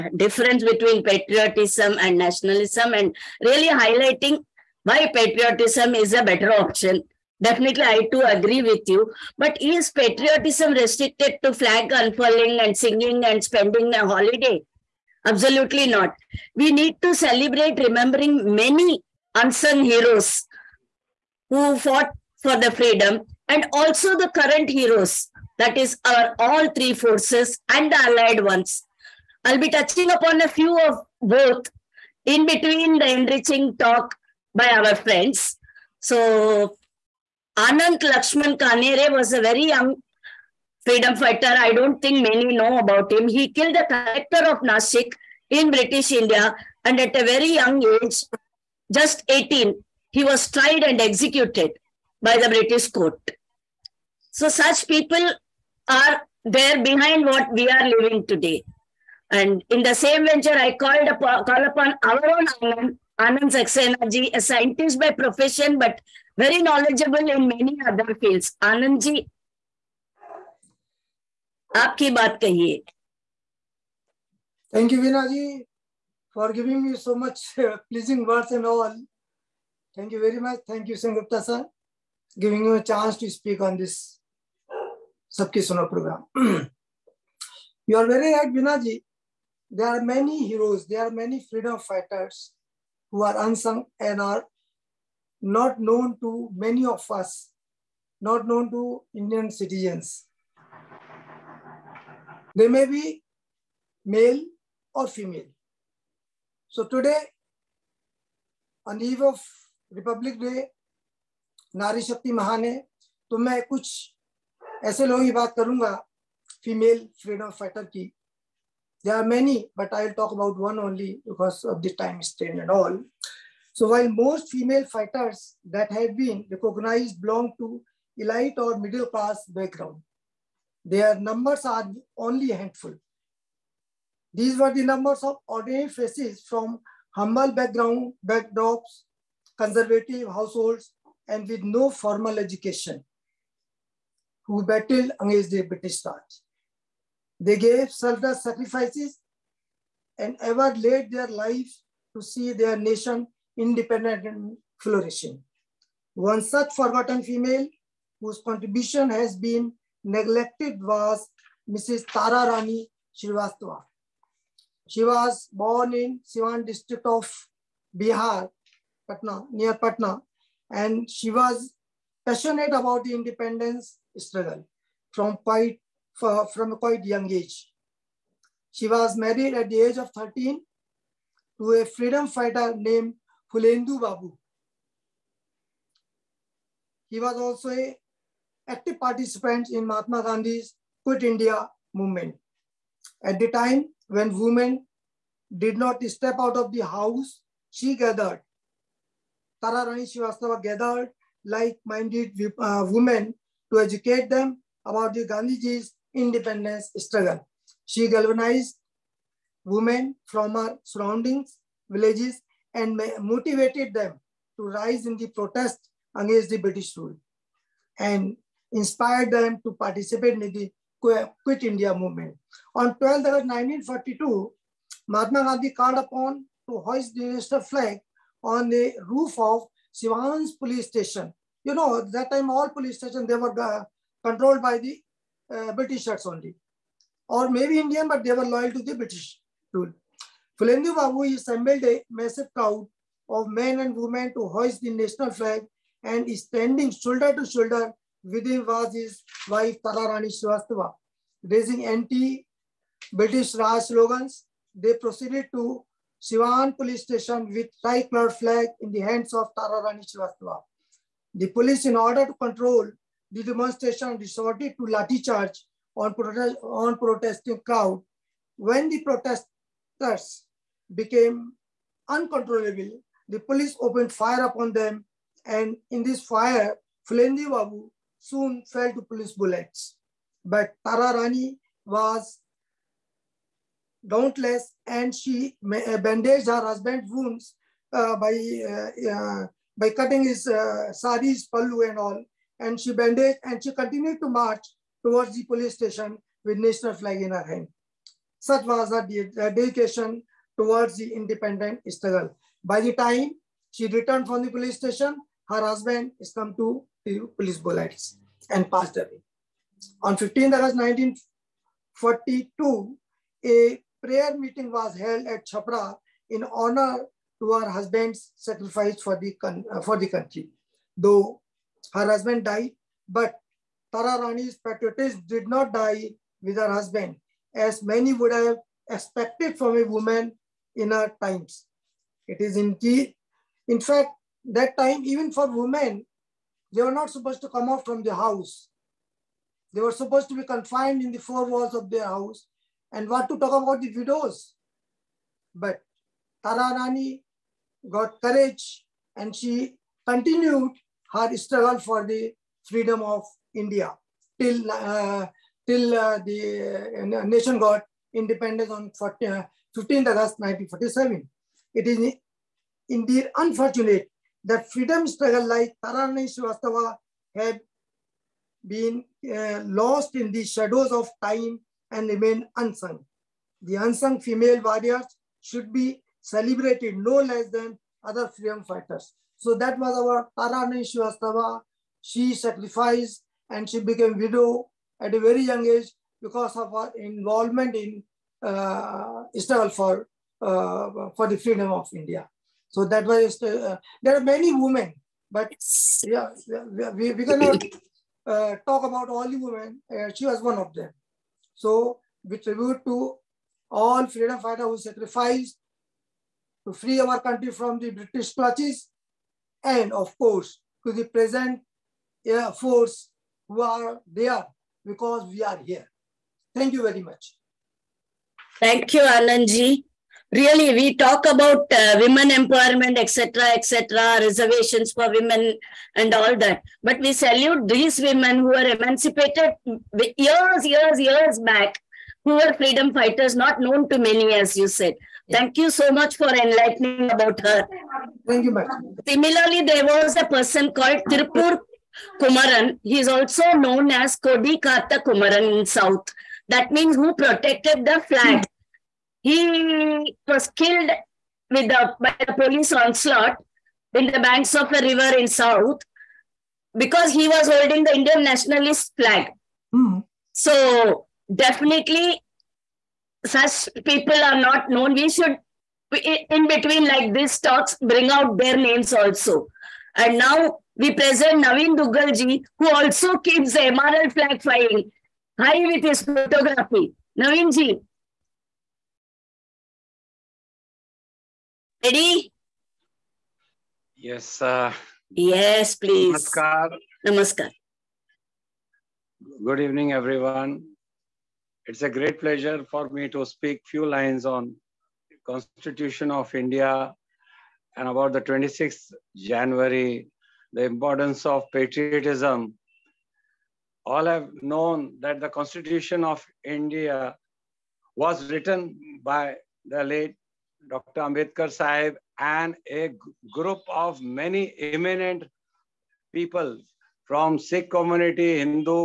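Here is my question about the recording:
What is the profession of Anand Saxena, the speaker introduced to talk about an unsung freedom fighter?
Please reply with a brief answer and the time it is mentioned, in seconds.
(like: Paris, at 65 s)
Scientist, at 64 s.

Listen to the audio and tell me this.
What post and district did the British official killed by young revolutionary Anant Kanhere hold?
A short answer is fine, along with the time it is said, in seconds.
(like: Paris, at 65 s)
Collector of Nasik, at 43 s.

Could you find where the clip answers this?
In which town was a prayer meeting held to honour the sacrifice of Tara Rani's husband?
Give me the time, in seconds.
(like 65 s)
315 s.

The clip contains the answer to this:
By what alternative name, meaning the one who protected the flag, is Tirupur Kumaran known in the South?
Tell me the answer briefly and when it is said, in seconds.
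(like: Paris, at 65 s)
Kodi Katha Kumaran, at 444 s.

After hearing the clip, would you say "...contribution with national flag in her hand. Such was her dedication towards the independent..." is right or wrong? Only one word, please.
wrong.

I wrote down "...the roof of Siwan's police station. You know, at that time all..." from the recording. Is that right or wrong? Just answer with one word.
right.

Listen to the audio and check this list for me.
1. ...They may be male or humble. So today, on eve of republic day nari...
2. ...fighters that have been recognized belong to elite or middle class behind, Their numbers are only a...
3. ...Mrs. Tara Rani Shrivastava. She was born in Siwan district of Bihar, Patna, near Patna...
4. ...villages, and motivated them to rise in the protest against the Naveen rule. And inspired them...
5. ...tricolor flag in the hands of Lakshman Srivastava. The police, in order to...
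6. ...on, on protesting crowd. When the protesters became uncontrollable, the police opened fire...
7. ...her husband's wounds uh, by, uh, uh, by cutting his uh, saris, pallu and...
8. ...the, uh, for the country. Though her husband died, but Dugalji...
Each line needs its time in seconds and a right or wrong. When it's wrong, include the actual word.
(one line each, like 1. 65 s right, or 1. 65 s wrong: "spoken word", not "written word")
1. 102 s wrong: "female", not "humble"
2. 124 s wrong: "background", not "behind"
3. 161 s right
4. 211 s wrong: "British", not "Naveen"
5. 257 s wrong: "Tararani", not "Lakshman"
6. 265 s right
7. 286 s right
8. 319 s wrong: "Tara", not "Dugalji".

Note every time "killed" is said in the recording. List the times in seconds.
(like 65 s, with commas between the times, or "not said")
43 s, 450 s.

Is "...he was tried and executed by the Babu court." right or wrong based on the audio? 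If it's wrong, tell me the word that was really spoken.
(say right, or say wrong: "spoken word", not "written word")
wrong: "British", not "Babu".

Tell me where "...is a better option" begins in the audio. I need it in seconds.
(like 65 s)
5 s.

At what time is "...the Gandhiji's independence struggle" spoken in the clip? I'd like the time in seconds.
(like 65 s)
205 s.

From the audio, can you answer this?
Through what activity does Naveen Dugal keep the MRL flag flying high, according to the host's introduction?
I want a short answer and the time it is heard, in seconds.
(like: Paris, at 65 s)
Photography, at 476 s.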